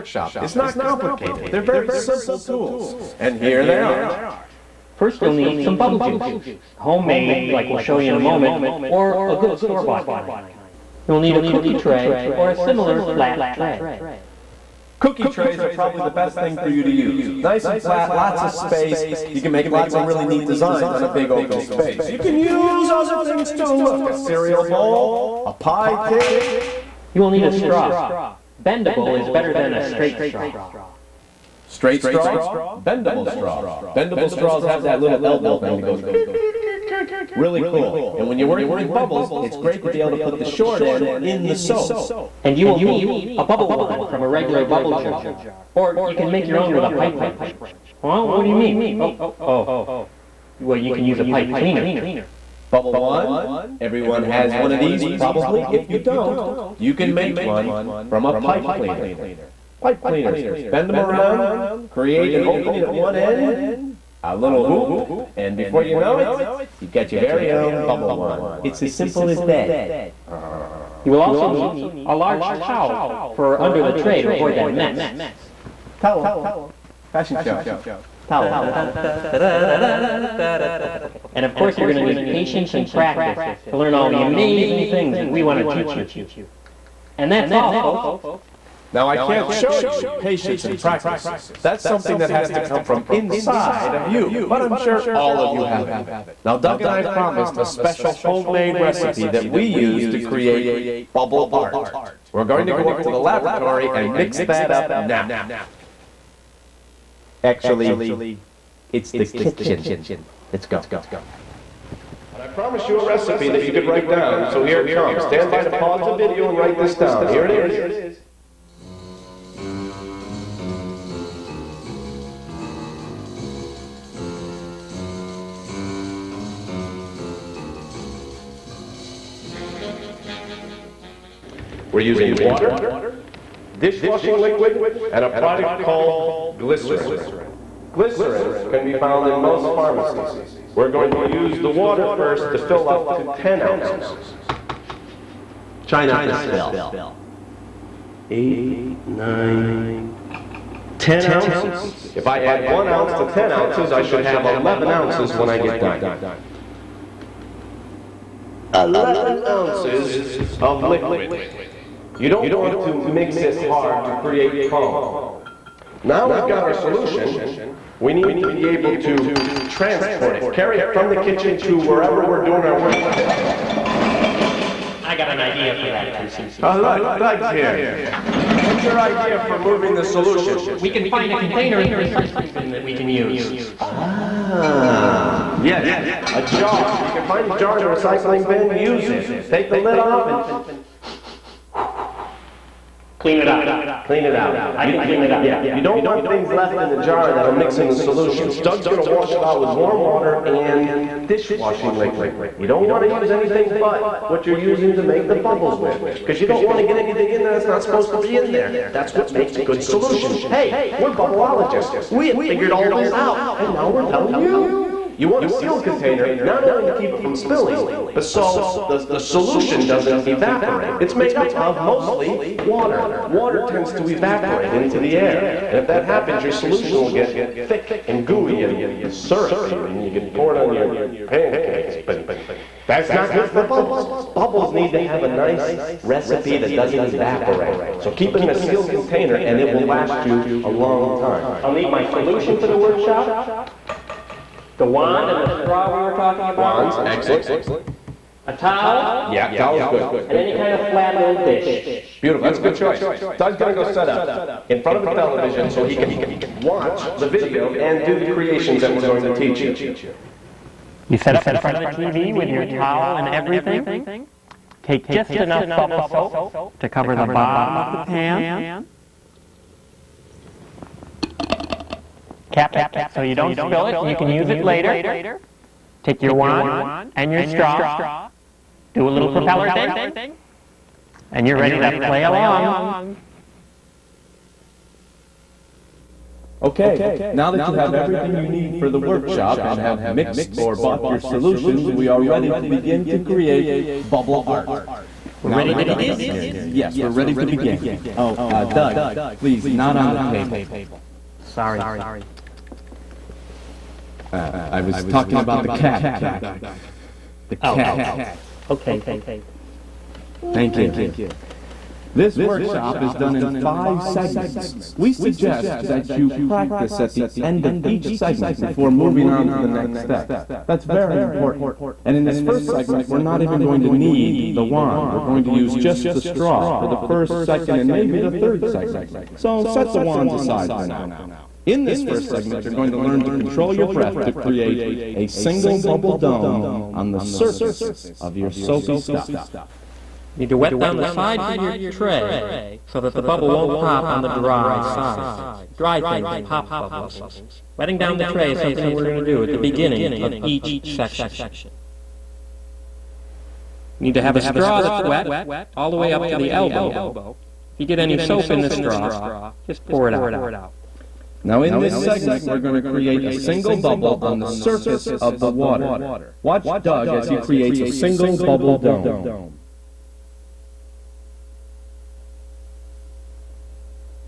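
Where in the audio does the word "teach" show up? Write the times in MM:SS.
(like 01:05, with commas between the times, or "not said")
01:25, 04:19.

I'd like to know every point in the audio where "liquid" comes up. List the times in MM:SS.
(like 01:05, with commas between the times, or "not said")
02:14, 02:40, 03:21.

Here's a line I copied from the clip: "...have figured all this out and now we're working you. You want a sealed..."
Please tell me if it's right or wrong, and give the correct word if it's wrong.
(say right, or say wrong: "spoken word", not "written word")
wrong: "telling", not "working".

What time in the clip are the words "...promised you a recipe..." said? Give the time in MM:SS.
01:52.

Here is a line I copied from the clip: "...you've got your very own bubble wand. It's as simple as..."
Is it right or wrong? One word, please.
right.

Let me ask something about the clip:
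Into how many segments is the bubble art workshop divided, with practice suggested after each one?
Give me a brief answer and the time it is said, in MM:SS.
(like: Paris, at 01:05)
5, at 05:13.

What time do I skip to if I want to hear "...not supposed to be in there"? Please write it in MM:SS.
03:27.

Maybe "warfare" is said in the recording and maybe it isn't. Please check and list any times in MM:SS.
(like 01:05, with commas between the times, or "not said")
not said.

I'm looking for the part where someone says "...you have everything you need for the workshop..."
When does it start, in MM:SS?
04:47.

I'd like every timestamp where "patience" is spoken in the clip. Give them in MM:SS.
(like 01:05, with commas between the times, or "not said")
01:22, 01:30.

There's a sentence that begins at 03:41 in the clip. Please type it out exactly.
It's made up of mostly water.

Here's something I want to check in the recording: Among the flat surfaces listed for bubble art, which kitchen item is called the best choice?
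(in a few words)
Cookie tray.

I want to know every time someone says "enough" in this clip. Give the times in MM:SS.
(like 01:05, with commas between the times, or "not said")
04:25.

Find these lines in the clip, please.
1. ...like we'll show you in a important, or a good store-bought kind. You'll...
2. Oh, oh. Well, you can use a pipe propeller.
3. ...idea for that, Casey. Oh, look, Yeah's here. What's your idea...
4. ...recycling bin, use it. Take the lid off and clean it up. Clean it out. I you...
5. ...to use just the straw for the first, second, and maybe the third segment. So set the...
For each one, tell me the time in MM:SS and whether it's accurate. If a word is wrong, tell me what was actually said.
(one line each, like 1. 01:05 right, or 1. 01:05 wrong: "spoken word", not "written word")
1. 00:07 wrong: "moment", not "important"
2. 00:48 wrong: "cleaner", not "propeller"
3. 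02:55 wrong: "Doug", not "Yeah"
4. 03:07 right
5. 05:25 right.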